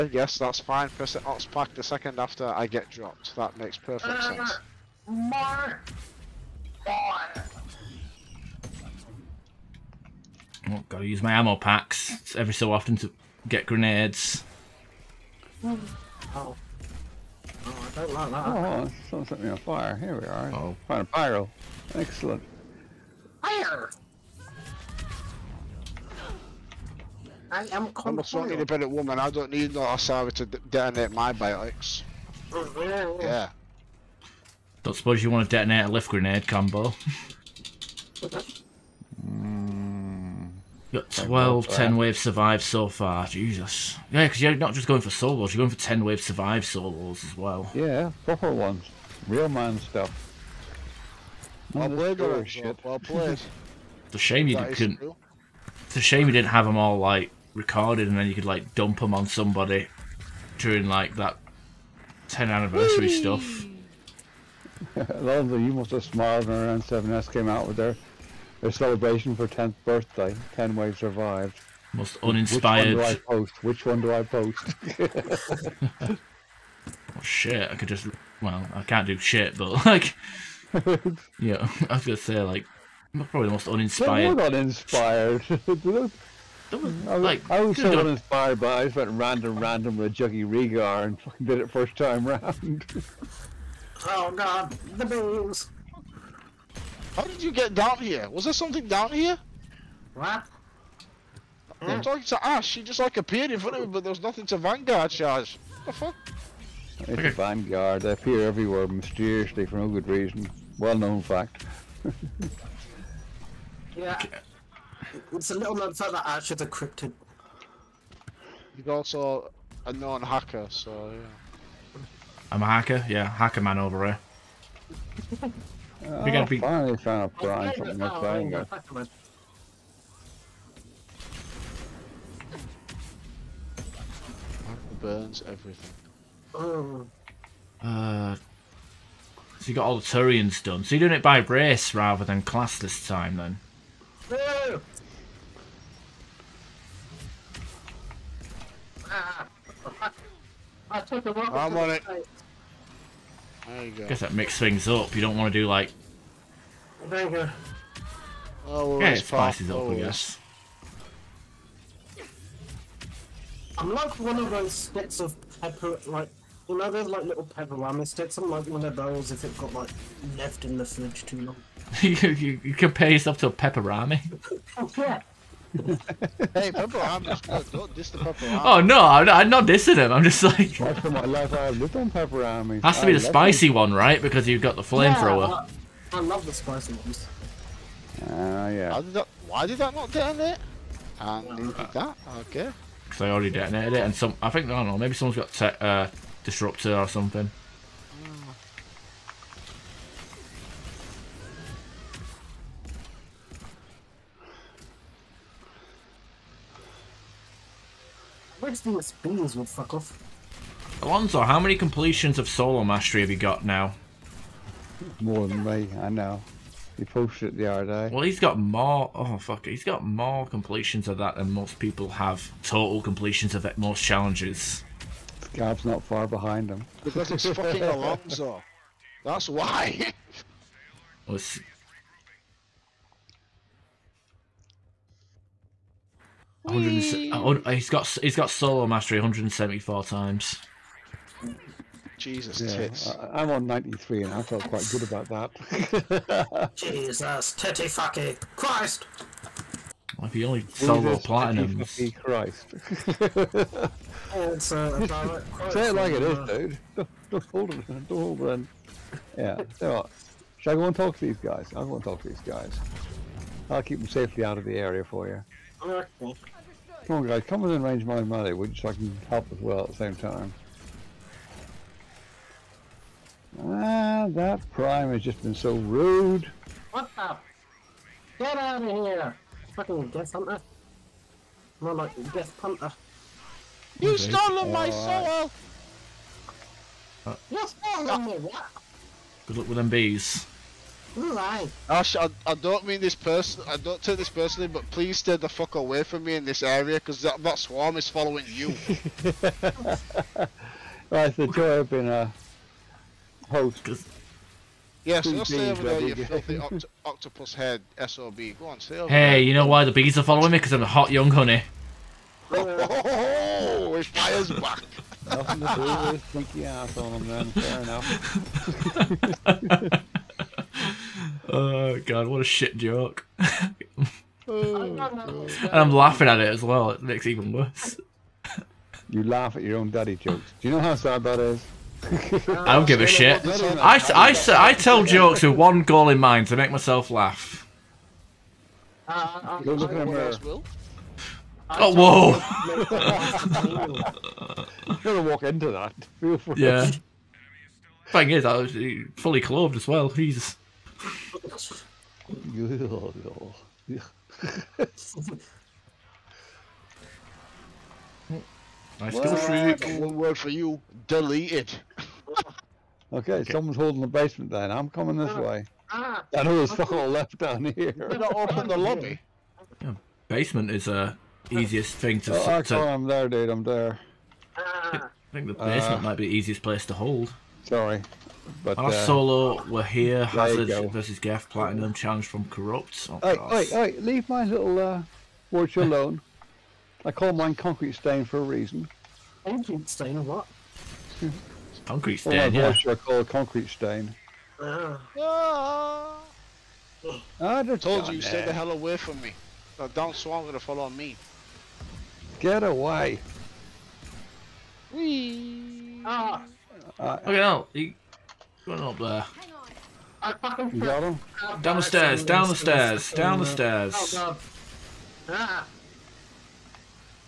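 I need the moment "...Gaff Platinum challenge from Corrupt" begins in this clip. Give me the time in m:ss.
6:21.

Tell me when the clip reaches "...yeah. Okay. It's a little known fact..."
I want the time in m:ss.
1:53.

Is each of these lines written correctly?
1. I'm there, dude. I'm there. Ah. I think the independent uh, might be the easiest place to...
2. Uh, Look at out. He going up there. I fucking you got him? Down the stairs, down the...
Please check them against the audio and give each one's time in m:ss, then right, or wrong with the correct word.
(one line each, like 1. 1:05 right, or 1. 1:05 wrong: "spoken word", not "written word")
1. 6:12 wrong: "basement", not "independent"
2. 6:47 right.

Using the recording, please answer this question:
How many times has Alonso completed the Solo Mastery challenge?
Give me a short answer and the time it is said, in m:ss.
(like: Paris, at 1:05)
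174, at 3:59.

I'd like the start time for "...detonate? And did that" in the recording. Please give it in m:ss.
3:10.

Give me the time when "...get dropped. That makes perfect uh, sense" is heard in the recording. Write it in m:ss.
0:02.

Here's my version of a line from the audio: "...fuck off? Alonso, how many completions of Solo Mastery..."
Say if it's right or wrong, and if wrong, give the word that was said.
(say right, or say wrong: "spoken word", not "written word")
right.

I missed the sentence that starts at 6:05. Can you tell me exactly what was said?
Ah, I know there's fuck all left down here.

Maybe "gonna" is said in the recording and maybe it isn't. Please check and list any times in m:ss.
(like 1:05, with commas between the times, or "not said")
1:22, 2:06, 5:45, 6:40.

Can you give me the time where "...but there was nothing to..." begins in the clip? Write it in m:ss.
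1:43.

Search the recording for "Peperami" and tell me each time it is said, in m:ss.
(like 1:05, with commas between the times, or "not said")
2:47, 2:53.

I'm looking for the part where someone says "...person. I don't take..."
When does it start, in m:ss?
4:53.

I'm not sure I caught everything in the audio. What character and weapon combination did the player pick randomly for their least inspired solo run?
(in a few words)
Juggy Reegar.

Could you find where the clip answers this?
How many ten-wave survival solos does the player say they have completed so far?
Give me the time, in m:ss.
0:41.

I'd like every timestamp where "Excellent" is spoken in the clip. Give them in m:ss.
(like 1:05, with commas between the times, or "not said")
0:21.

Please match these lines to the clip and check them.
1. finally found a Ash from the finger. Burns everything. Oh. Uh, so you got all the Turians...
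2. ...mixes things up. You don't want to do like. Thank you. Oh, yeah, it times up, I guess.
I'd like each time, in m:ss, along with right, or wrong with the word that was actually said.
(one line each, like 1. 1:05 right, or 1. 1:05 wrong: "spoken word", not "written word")
1. 2:06 wrong: "Brian", not "Ash"
2. 2:34 wrong: "spices", not "times".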